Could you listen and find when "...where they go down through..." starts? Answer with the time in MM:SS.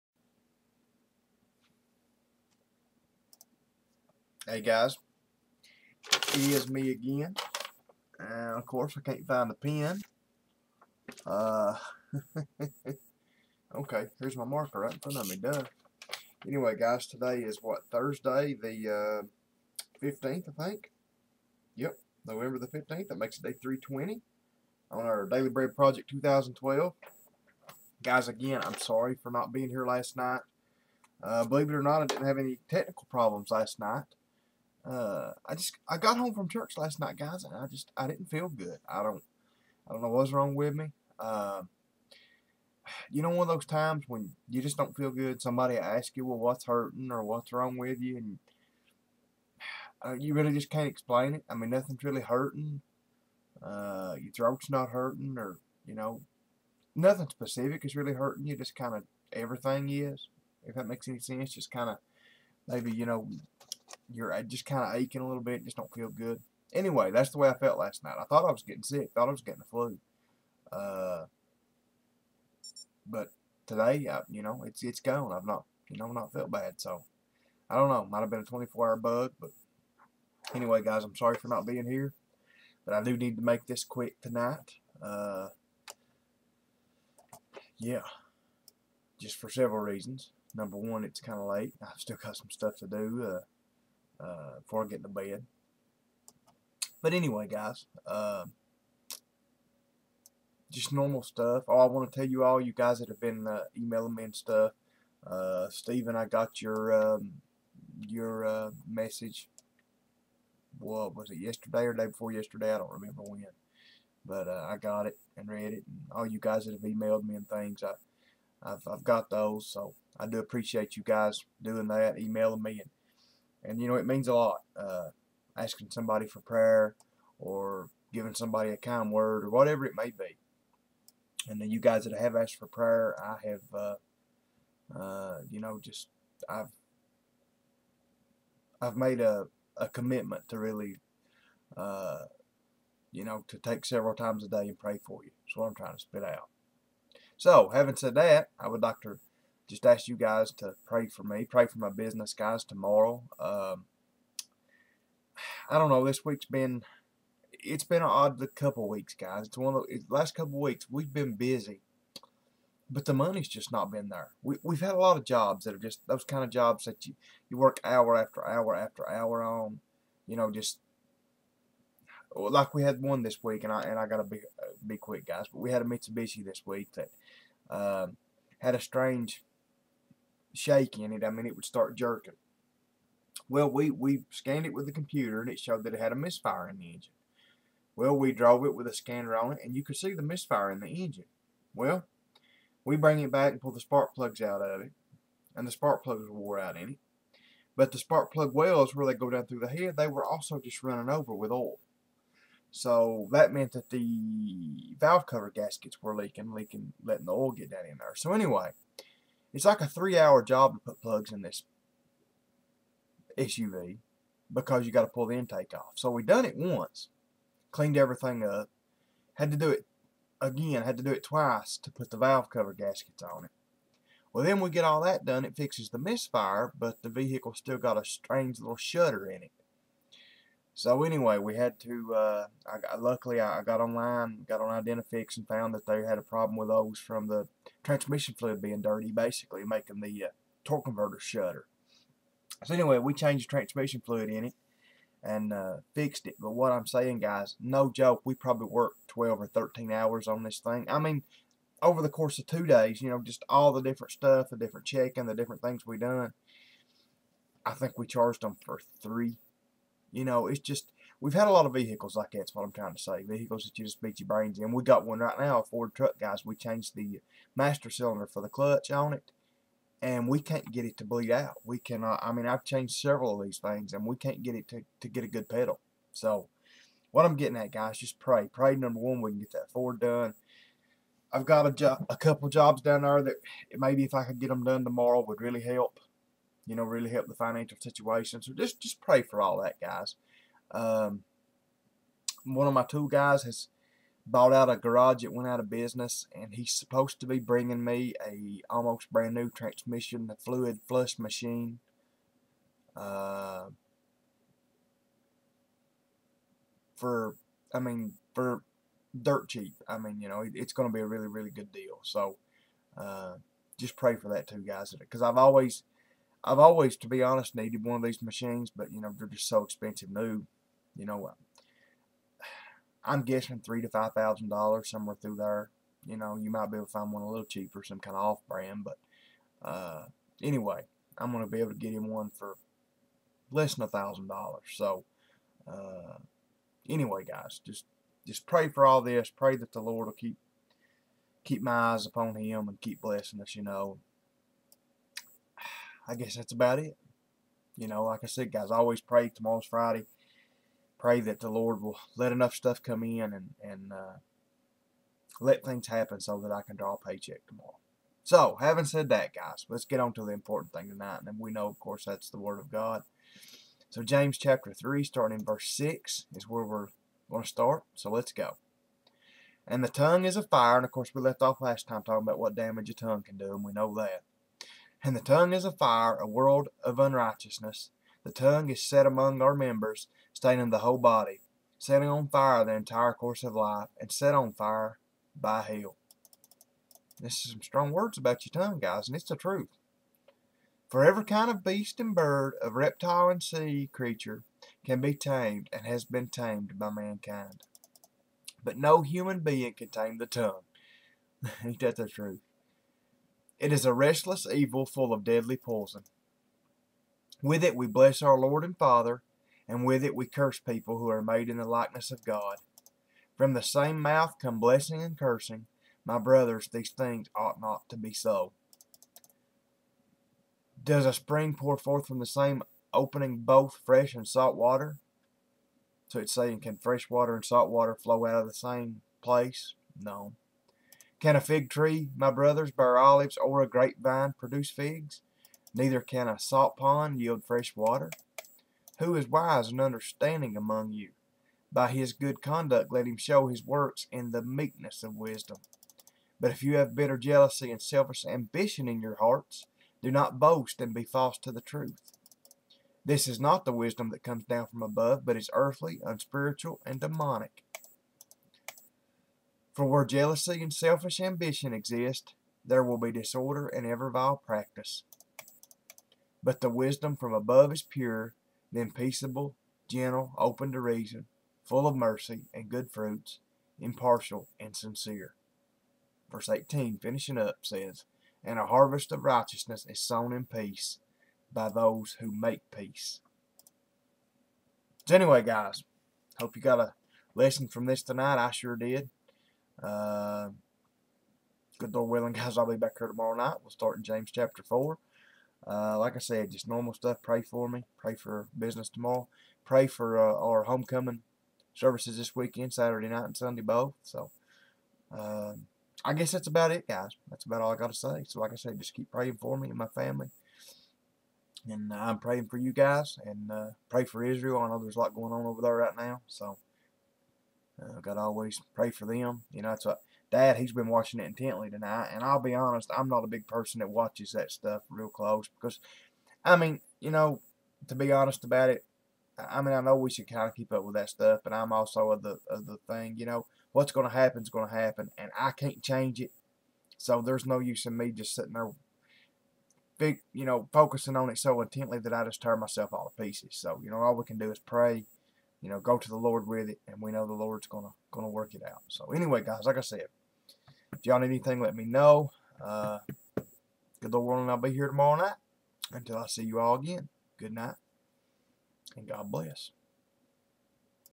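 03:18.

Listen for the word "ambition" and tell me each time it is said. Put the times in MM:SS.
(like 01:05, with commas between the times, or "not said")
07:28, 07:41.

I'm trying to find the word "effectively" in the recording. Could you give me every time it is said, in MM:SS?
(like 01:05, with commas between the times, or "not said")
not said.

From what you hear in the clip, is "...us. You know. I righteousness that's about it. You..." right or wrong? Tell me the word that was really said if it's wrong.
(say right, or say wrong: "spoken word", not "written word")
wrong: "guess", not "righteousness".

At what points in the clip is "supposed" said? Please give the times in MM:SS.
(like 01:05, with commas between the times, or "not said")
04:56.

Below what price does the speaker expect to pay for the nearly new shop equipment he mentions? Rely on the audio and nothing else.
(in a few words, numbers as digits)
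$1,000.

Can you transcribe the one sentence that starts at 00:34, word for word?
Uh, I just I got home from church last night, guys, and I just I didn't feel good.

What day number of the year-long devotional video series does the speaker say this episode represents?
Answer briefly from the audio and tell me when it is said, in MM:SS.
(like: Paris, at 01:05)
320, at 00:23.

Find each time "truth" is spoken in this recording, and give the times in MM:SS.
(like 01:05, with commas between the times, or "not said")
06:29, 06:42, 07:31.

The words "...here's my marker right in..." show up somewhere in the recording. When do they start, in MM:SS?
00:14.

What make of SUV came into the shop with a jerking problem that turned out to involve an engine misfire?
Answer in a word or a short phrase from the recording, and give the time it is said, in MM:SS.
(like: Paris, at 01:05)
Mitsubishi, at 02:55.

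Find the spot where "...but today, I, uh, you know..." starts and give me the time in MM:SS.
01:13.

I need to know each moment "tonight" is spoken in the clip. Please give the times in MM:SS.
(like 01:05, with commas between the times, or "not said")
01:24, 06:00, 08:08, 08:41.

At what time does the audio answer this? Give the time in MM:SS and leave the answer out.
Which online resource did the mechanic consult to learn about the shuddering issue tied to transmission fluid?
03:54.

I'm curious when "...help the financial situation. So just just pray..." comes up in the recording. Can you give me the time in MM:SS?
04:47.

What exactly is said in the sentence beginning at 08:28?
So, like I said, just keep praying for me and my family.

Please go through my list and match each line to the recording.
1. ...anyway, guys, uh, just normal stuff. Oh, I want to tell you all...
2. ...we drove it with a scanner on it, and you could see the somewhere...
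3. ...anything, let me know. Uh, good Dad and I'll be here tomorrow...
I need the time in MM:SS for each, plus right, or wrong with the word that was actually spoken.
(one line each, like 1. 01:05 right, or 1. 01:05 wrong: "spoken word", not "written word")
1. 01:37 right
2. 03:08 wrong: "misfire", not "somewhere"
3. 09:11 wrong: "Lord", not "Dad".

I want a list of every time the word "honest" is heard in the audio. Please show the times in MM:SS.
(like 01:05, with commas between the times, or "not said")
05:17, 08:42, 08:48.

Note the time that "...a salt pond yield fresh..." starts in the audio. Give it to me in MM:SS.
07:16.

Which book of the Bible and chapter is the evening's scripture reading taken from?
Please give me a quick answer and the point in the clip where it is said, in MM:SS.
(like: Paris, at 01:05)
James chapter 3, at 06:04.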